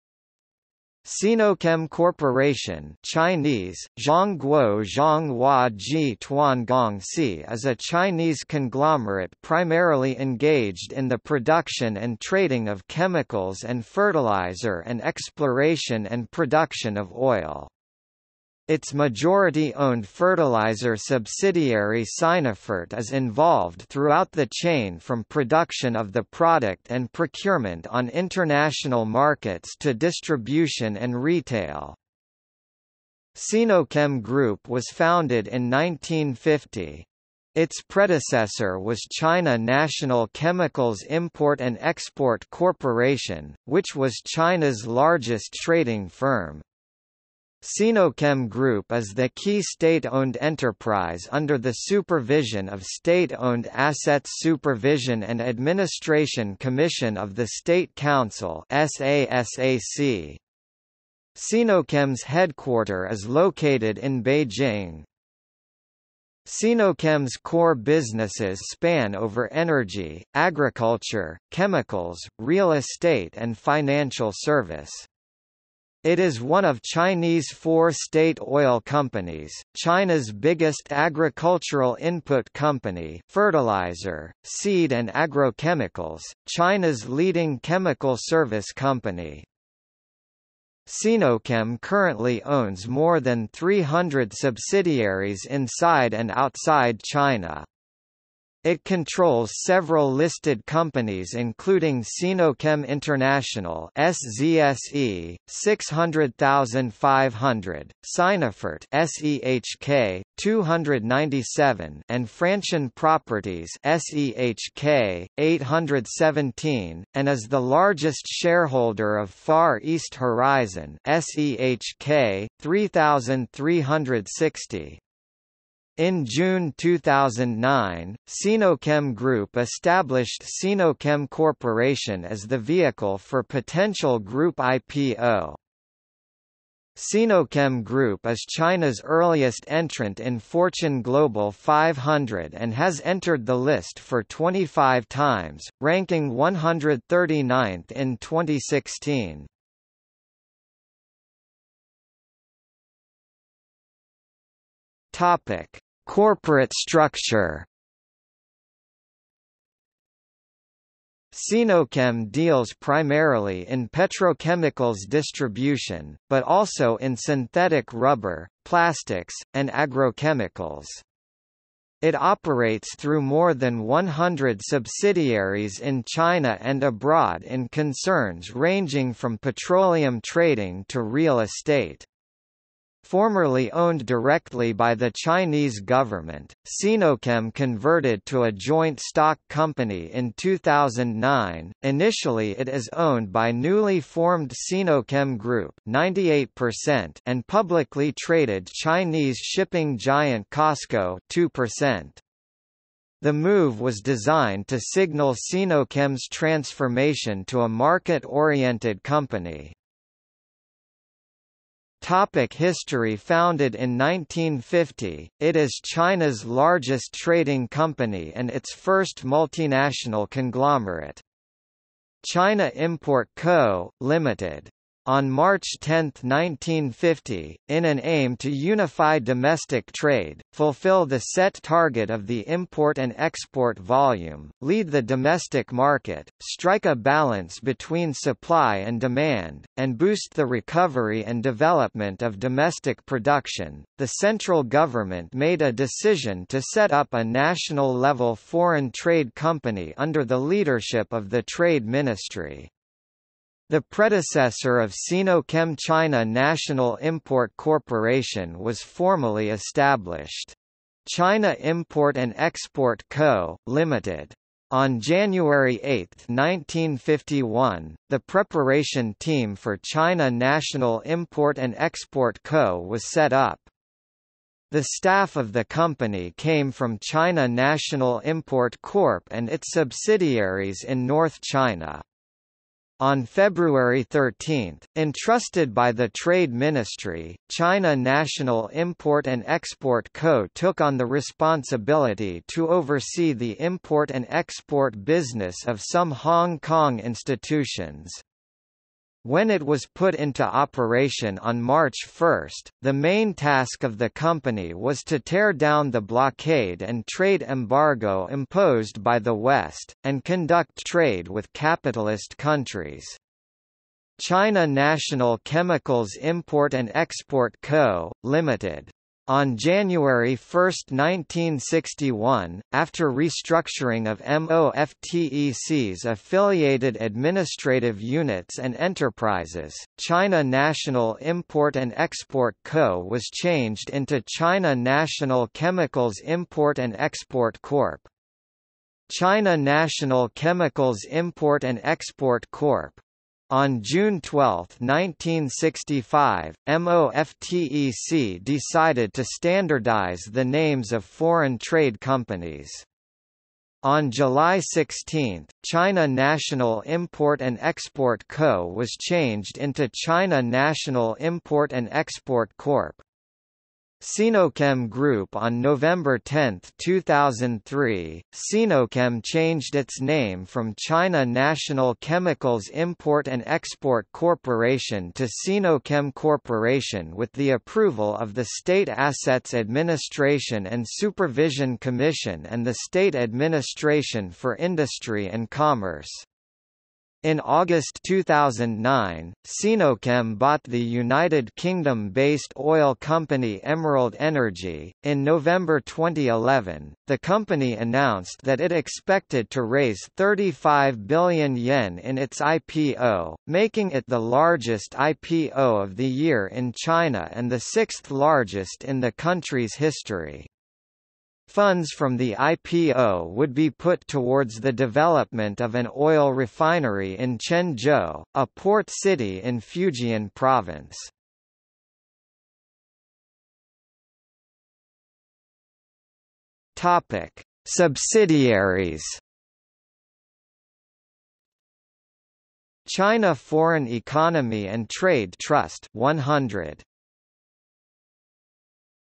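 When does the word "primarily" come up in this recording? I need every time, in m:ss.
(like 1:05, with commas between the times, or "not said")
0:09, 2:42.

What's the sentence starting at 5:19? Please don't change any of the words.
On January 1, 1961, after restructuring of MOFTEC's affiliated administrative units and enterprises, China National Import and Export Co.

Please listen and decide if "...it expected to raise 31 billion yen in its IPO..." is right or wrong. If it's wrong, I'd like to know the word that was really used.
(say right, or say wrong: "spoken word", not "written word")
wrong: "35", not "31".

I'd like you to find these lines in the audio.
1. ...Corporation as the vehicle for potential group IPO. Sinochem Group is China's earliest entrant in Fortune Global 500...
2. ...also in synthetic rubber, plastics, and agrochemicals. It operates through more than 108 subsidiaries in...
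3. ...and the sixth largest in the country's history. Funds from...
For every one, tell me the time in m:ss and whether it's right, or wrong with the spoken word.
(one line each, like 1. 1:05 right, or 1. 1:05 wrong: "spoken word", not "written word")
1. 2:11 right
2. 2:46 wrong: "100", not "108"
3. 6:47 right.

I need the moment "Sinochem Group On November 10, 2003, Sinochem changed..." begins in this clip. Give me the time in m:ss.
6:04.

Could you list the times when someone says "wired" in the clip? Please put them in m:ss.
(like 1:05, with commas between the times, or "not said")
not said.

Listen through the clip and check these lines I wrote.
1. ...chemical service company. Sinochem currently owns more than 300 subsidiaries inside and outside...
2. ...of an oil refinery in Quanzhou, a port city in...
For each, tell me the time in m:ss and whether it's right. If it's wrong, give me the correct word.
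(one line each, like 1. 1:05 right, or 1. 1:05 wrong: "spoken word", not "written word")
1. 1:27 right
2. 6:55 right.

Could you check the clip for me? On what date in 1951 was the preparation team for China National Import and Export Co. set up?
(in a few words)
January 8.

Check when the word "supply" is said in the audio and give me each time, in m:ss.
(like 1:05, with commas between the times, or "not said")
3:58.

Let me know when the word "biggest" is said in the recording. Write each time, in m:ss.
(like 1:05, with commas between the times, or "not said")
1:20.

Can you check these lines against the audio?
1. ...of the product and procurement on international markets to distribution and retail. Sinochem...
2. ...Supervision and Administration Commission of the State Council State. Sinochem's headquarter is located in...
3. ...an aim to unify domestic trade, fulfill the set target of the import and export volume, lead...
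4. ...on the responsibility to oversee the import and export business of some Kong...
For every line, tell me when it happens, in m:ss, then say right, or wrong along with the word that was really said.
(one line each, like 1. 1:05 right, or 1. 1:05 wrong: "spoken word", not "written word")
1. 0:25 right
2. 0:54 wrong: "SASAC", not "State"
3. 3:47 right
4. 4:50 wrong: "Hong", not "Kong".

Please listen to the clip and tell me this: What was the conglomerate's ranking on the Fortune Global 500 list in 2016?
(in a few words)
139th.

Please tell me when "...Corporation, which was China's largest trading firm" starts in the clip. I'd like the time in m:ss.
0:42.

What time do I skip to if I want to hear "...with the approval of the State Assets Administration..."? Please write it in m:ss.
6:17.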